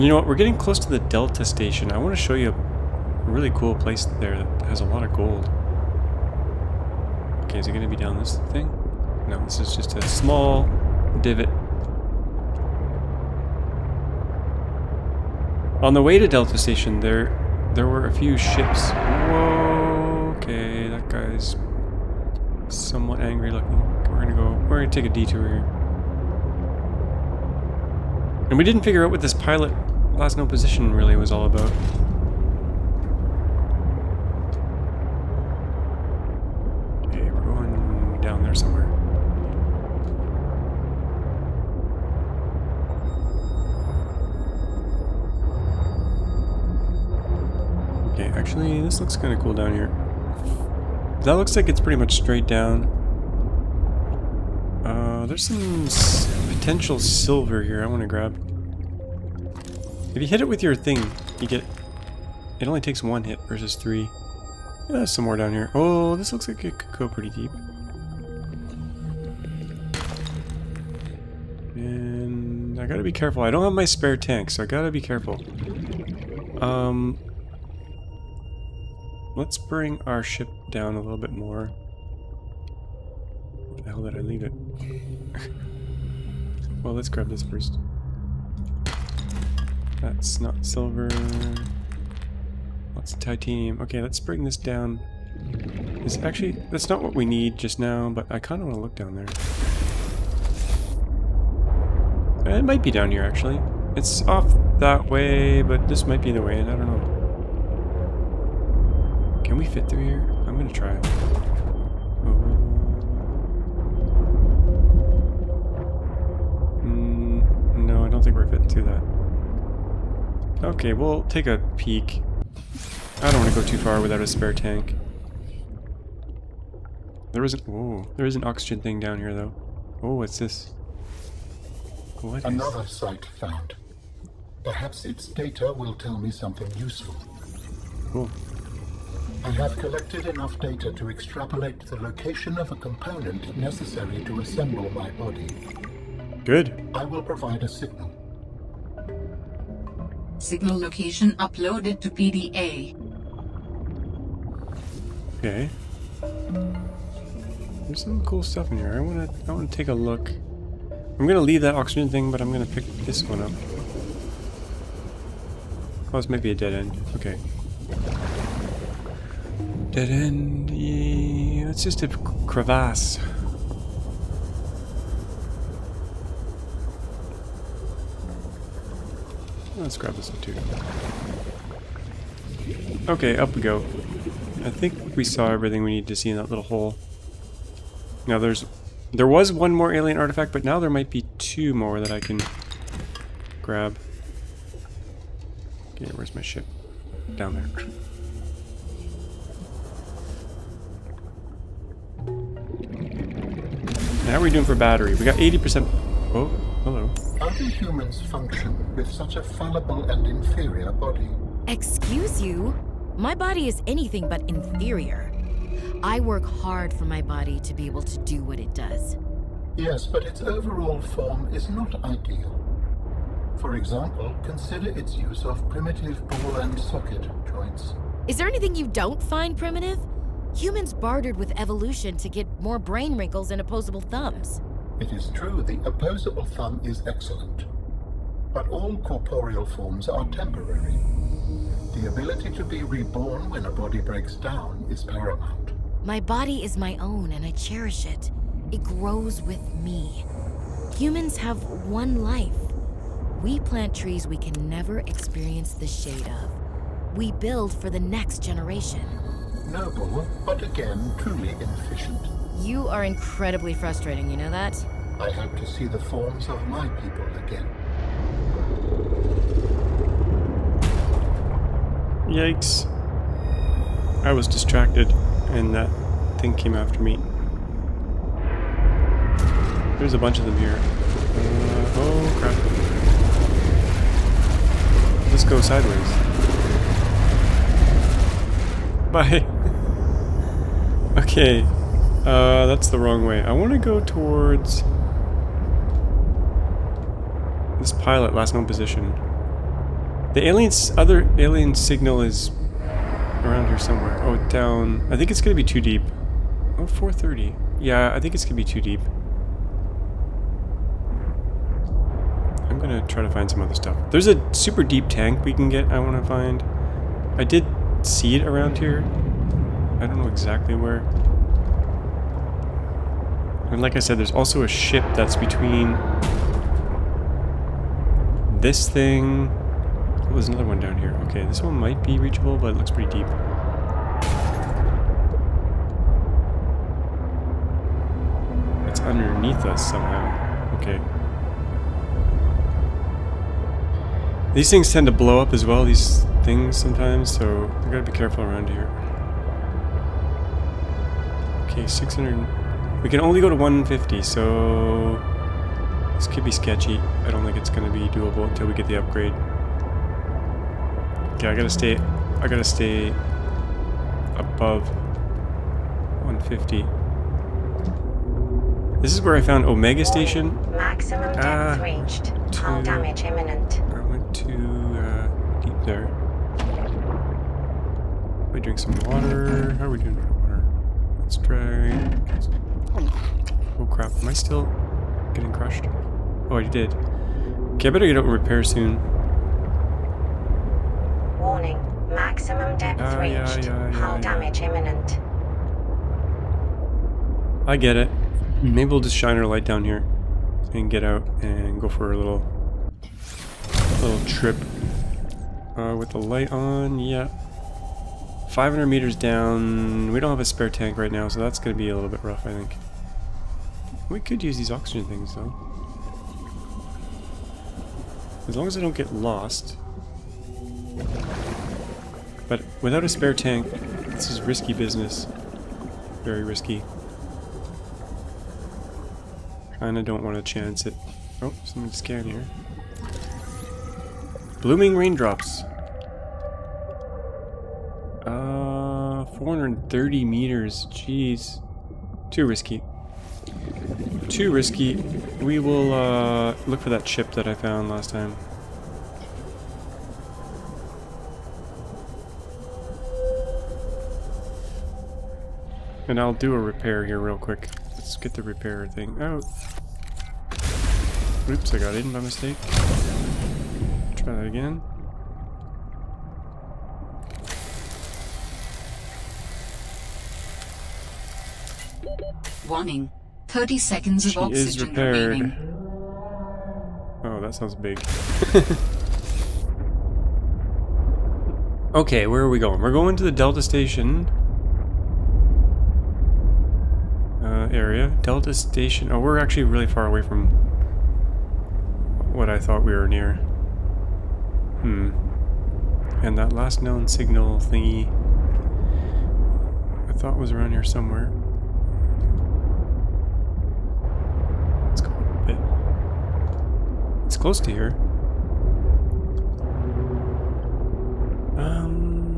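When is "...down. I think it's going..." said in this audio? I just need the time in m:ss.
5:04.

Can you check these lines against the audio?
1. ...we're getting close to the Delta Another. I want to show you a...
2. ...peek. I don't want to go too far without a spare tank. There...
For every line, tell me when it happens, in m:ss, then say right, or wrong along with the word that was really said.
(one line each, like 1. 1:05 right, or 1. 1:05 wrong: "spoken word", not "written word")
1. 0:00 wrong: "Station", not "Another"
2. 2:01 right.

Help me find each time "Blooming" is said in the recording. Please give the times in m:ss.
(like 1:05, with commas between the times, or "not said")
7:14.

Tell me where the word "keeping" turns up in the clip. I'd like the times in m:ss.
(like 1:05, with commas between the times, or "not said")
not said.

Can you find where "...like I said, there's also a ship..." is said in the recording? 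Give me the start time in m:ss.
5:23.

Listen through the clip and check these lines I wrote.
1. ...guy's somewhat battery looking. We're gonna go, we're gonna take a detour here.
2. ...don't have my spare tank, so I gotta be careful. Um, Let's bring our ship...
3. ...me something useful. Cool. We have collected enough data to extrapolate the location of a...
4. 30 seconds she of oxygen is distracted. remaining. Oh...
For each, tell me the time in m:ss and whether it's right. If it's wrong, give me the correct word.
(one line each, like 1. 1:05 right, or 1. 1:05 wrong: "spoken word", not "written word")
1. 0:21 wrong: "angry", not "battery"
2. 1:13 right
3. 2:16 right
4. 7:53 wrong: "repaired", not "distracted".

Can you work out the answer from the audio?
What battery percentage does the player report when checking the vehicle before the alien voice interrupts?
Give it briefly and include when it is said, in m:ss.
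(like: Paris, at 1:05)
80%, at 3:25.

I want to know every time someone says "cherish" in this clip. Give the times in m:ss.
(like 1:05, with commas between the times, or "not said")
4:07.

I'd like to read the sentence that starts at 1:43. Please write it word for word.
It's off that way, but this might be the way, and I don't know.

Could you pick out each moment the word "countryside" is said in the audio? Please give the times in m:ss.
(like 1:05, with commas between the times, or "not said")
not said.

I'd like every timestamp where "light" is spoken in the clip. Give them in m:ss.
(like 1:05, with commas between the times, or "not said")
6:39, 6:46.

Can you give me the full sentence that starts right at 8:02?
We're going to the Delta Station.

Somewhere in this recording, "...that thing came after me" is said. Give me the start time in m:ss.
4:35.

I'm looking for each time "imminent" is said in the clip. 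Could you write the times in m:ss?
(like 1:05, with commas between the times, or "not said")
6:13, 6:34.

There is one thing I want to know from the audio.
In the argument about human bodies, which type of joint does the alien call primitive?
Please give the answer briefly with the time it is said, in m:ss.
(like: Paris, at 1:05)
Ball and socket joints, at 3:46.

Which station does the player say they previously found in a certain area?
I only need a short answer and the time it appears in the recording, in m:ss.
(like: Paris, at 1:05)
Omega Station, at 6:09.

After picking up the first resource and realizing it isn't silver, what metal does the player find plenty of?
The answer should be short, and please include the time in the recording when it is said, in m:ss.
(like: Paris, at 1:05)
Titanium, at 1:32.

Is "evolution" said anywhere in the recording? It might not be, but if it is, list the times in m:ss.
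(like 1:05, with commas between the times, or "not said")
3:51.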